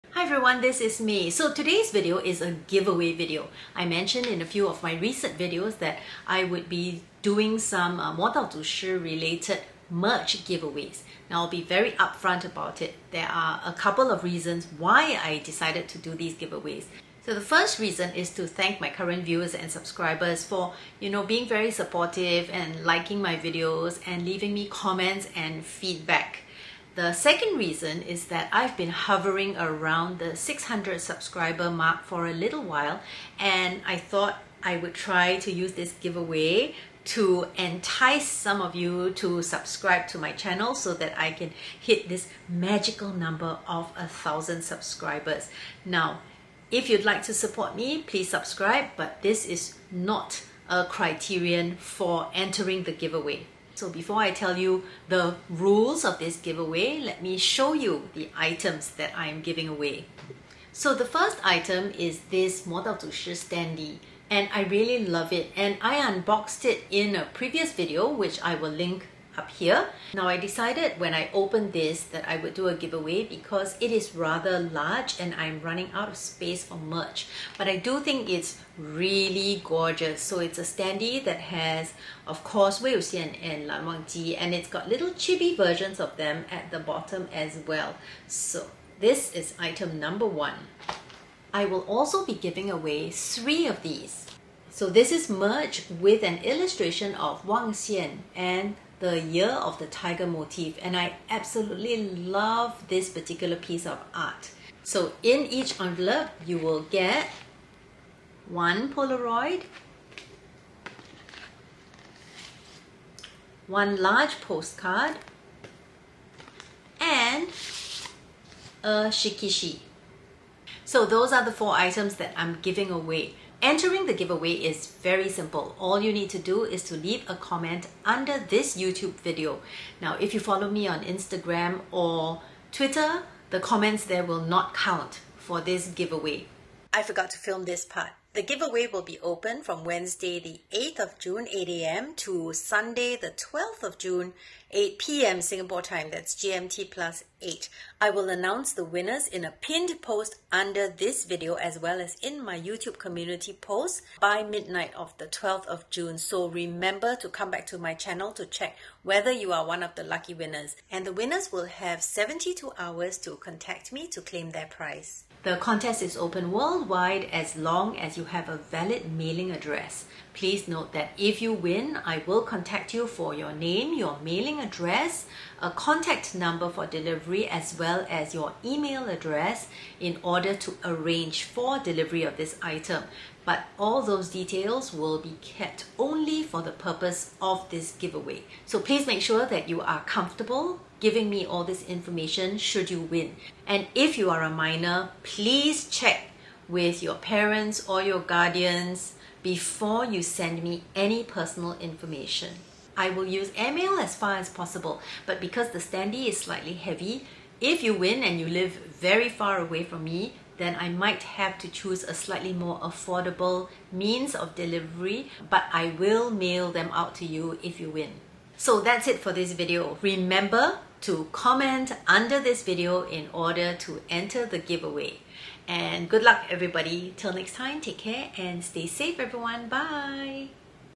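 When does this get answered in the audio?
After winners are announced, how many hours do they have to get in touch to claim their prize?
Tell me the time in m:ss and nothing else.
2:42.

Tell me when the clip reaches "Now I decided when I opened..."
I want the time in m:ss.
1:10.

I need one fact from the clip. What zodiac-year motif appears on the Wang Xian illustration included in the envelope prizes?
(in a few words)
year of the tiger.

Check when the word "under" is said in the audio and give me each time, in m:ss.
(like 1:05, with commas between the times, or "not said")
2:08, 2:30, 3:42.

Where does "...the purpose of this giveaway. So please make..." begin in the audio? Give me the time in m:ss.
3:06.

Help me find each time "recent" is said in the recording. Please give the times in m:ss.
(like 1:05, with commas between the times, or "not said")
0:04.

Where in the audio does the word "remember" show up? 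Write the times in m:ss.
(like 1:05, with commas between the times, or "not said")
2:36, 3:40.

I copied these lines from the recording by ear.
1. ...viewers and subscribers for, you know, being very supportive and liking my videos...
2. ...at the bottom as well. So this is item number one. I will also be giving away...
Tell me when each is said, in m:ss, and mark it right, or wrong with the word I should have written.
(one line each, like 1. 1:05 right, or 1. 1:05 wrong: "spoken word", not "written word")
1. 0:19 right
2. 1:26 right.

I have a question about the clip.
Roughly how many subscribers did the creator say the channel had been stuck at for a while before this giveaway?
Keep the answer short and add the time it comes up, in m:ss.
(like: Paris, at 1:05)
600, at 0:30.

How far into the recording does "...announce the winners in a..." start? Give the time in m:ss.
2:28.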